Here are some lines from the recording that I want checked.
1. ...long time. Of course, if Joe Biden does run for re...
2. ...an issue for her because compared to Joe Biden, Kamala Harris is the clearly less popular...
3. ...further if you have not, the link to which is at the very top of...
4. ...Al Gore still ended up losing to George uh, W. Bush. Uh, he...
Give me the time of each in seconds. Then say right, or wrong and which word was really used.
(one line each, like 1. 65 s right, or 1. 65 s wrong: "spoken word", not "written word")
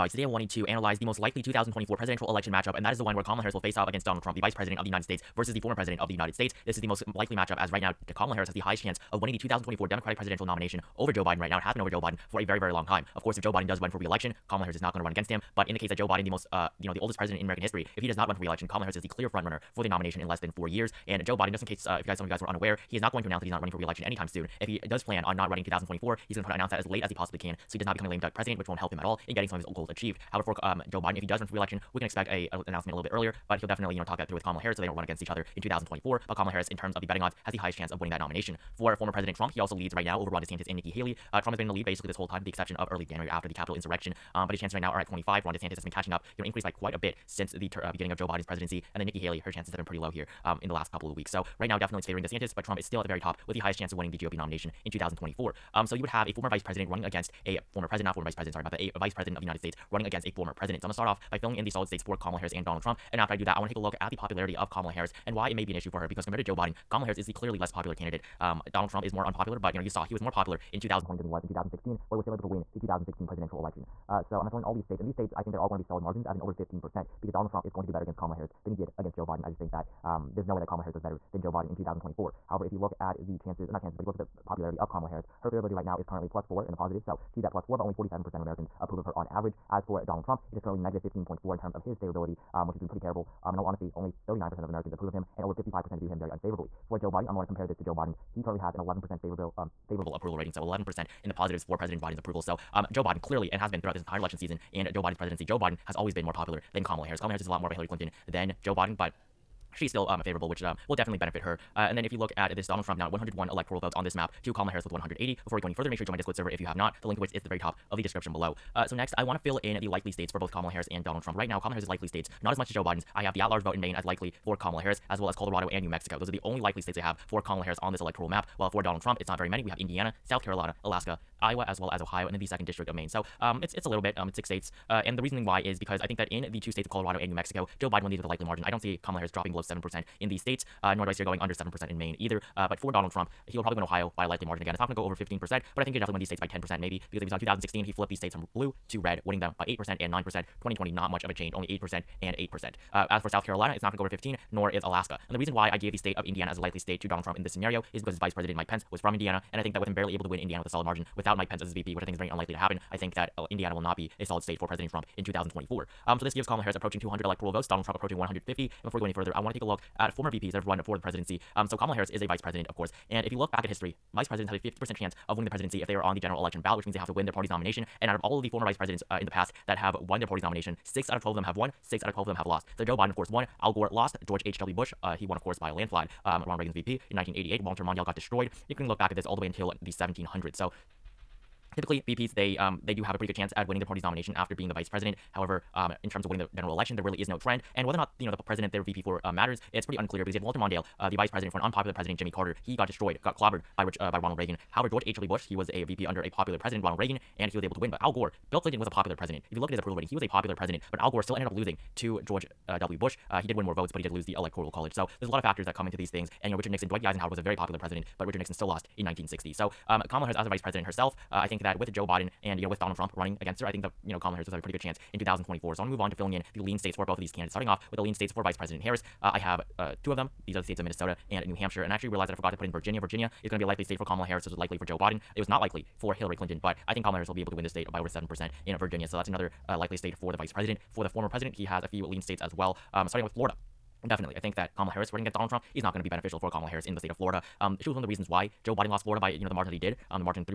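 1. 12 s right
2. 65 s right
3. 116 s wrong: "server", not "further"
4. 210 s right.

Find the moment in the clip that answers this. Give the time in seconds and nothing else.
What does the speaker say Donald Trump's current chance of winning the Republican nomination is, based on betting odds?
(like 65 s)
45 s.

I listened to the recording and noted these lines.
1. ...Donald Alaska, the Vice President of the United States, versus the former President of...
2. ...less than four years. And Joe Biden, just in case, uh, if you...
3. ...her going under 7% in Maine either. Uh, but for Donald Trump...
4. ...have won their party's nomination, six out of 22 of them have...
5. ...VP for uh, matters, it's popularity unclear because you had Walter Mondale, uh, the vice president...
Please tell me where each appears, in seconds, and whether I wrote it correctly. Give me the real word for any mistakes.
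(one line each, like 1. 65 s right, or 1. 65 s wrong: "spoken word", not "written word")
1. 4 s wrong: "Trump", not "Alaska"
2. 20 s right
3. 141 s right
4. 179 s wrong: "12", not "22"
5. 198 s wrong: "pretty", not "popularity".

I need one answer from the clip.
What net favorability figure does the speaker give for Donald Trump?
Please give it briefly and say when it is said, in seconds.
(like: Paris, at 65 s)
-15.4, at 90 s.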